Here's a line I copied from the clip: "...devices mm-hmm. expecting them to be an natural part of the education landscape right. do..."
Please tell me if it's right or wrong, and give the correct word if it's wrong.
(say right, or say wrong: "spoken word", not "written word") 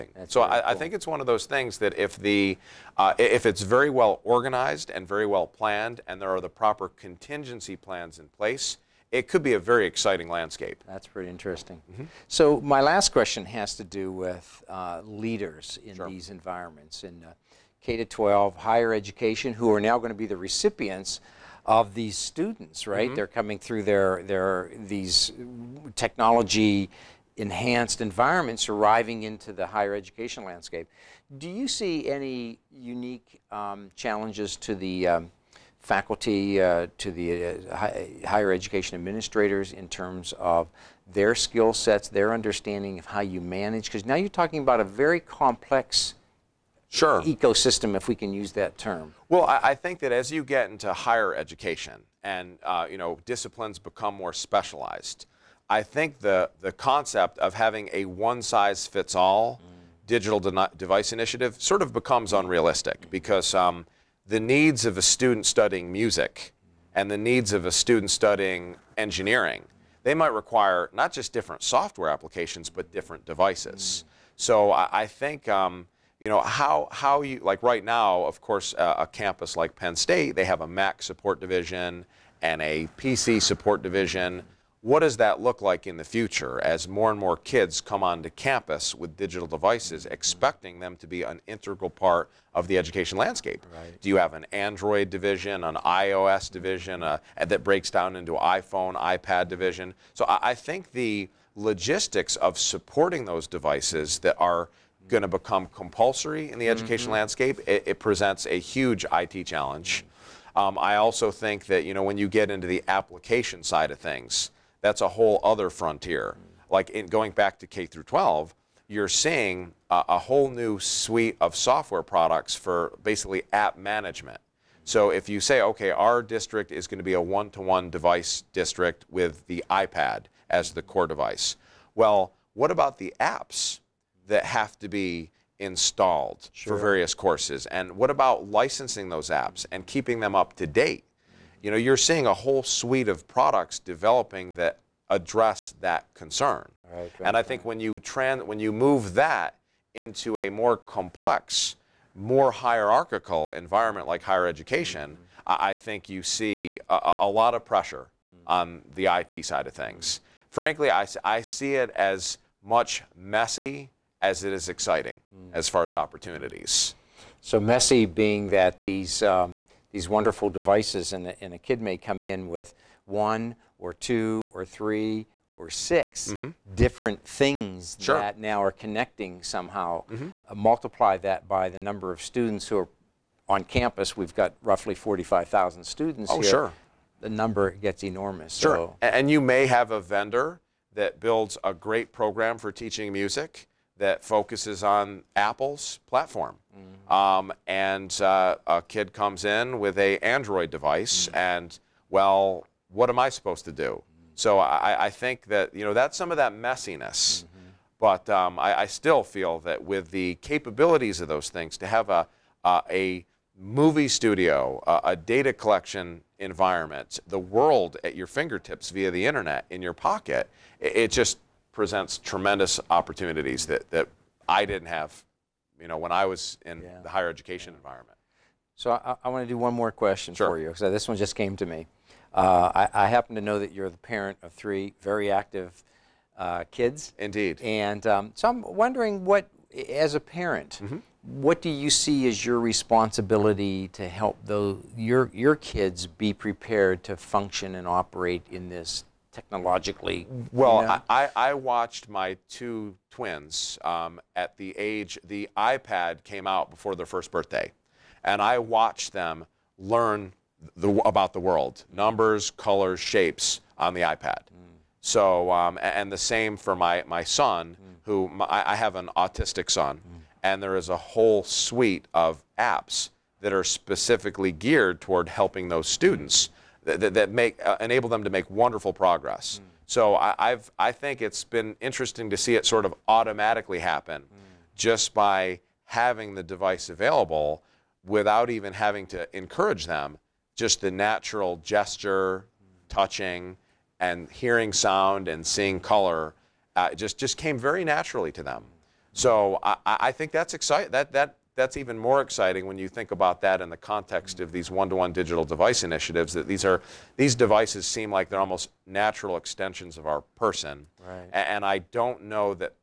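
wrong: "integral", not "natural".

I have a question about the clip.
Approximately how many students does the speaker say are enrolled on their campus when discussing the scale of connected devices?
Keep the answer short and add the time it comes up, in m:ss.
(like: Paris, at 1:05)
45,000, at 3:04.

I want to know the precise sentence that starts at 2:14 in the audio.
that have to be installed sure.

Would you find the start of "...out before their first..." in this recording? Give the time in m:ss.
4:16.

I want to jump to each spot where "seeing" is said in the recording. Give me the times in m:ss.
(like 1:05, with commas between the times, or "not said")
1:59, 2:21, 4:55.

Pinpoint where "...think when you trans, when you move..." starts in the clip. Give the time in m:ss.
2:27.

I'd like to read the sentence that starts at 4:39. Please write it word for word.
So I, have I think it's been interesting to see it sort of automatically happen, mm.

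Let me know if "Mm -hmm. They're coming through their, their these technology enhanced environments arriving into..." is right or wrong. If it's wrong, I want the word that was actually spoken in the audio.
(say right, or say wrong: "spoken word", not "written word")
right.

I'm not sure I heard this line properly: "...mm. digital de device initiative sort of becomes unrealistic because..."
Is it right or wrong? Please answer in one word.
right.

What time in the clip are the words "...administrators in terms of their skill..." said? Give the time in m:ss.
0:38.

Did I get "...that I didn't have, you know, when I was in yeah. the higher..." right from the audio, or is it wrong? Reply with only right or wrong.
right.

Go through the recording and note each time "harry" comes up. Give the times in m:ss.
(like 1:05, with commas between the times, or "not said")
not said.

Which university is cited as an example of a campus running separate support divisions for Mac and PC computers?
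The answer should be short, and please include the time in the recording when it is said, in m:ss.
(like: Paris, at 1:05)
Penn State, at 1:19.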